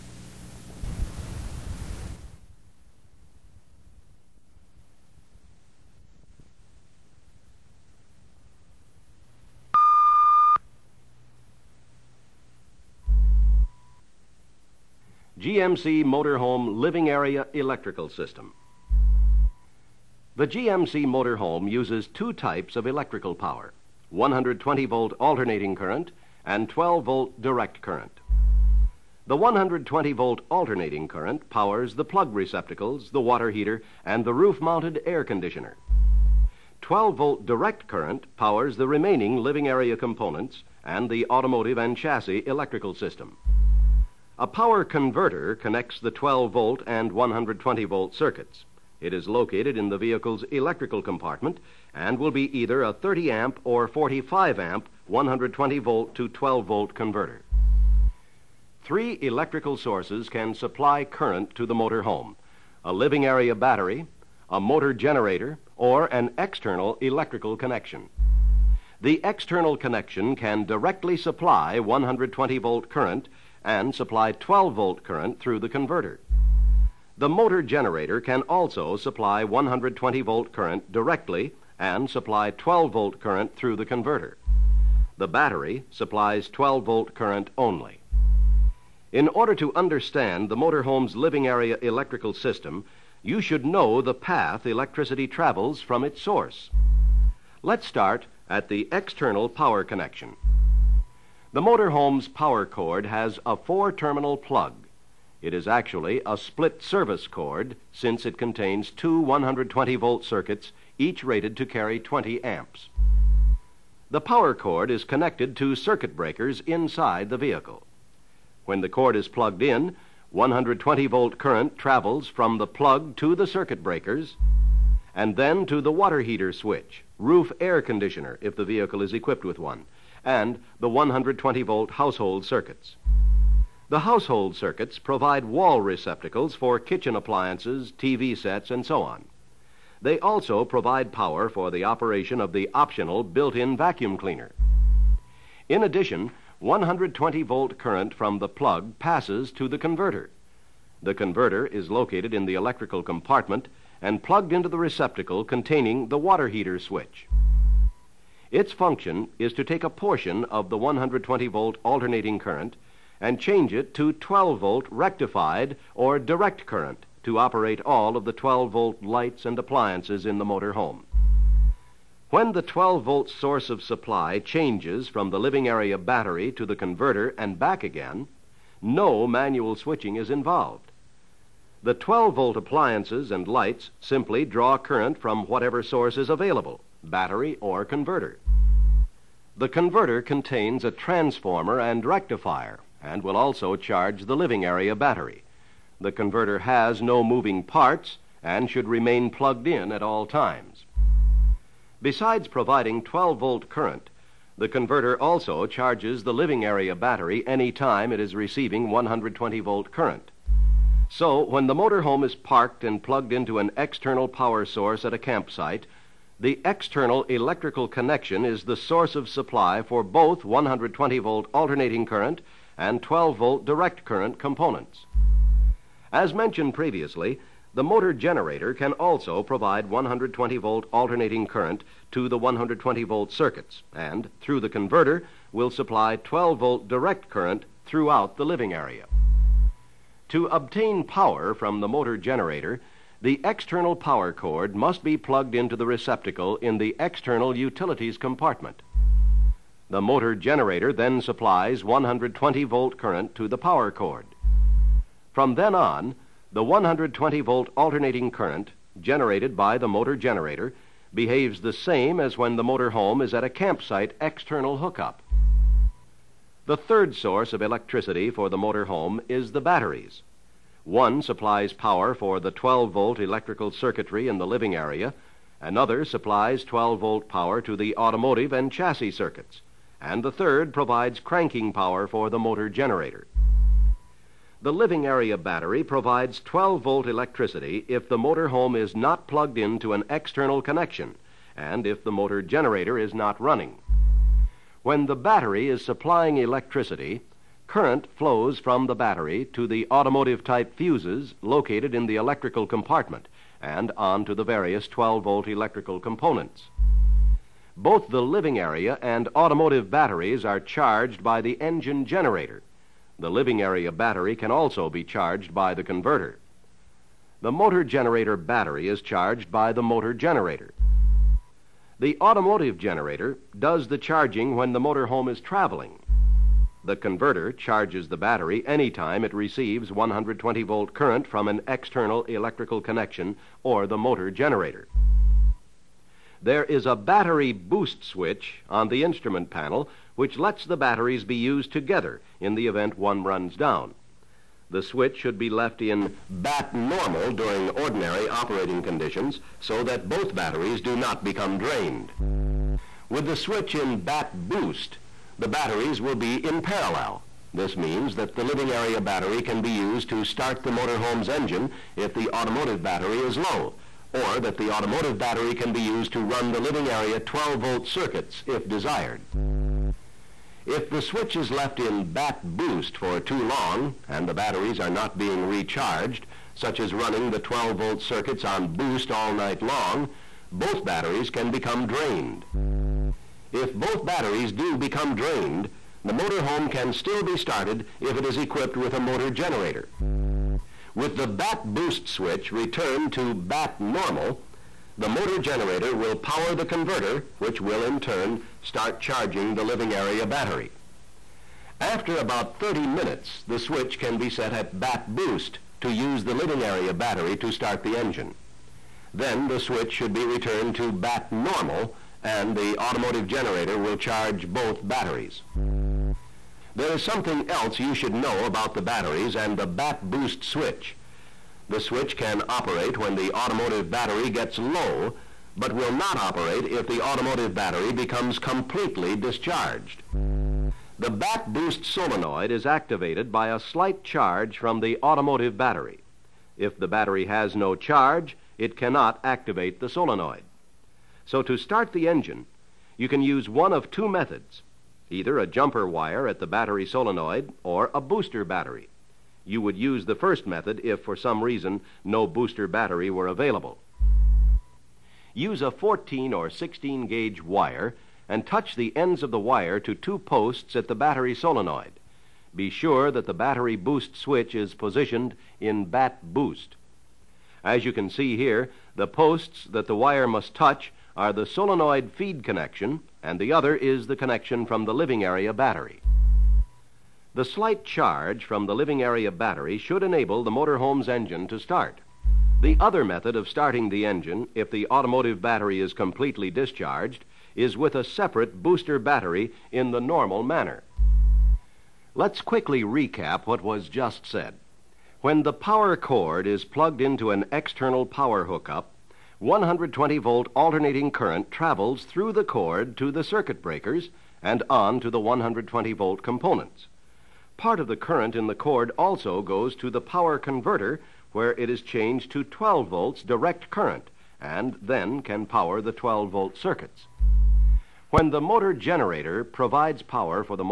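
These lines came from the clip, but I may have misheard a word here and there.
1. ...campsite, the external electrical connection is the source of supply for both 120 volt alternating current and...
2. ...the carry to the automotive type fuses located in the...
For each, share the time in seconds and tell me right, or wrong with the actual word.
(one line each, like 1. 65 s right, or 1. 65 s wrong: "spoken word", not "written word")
1. 215 s right
2. 298 s wrong: "battery", not "carry".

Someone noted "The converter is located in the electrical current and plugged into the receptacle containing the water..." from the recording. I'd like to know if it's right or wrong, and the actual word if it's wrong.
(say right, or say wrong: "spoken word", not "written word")
wrong: "compartment", not "current".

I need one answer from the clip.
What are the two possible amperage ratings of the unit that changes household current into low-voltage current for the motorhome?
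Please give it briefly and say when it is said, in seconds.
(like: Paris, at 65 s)
30 amp or 45 amp, at 52 s.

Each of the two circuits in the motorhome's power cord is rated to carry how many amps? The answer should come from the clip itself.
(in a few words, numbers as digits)
20.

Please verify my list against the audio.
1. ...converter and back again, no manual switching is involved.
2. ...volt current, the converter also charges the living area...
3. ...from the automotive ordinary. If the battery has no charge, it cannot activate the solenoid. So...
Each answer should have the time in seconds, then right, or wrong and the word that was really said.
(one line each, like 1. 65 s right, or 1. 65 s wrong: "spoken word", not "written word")
1. 176 s right
2. 203 s right
3. 434 s wrong: "battery", not "ordinary".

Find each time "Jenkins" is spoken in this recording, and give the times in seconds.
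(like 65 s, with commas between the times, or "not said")
not said.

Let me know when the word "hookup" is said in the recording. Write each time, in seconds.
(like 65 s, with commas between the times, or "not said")
264 s, 498 s.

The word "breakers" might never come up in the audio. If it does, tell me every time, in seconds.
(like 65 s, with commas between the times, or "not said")
116 s, 123 s, 503 s.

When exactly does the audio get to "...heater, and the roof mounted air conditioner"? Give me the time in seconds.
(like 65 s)
33 s.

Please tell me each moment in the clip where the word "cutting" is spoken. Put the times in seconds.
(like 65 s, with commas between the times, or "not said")
not said.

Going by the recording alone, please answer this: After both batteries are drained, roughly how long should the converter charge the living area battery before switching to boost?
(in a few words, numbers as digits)
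30 minutes.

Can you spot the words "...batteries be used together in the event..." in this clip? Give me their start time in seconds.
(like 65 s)
340 s.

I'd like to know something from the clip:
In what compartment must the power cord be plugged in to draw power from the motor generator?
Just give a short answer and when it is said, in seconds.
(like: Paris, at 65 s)
external utilities compartment, at 246 s.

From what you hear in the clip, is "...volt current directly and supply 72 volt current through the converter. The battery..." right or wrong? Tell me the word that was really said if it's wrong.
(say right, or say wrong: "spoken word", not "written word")
wrong: "12", not "72".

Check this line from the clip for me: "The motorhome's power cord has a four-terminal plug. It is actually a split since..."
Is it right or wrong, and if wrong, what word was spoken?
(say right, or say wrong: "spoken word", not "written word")
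wrong: "service", not "since".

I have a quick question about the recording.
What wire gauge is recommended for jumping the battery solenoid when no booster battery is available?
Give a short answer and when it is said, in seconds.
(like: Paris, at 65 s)
14 or 16 gauge, at 455 s.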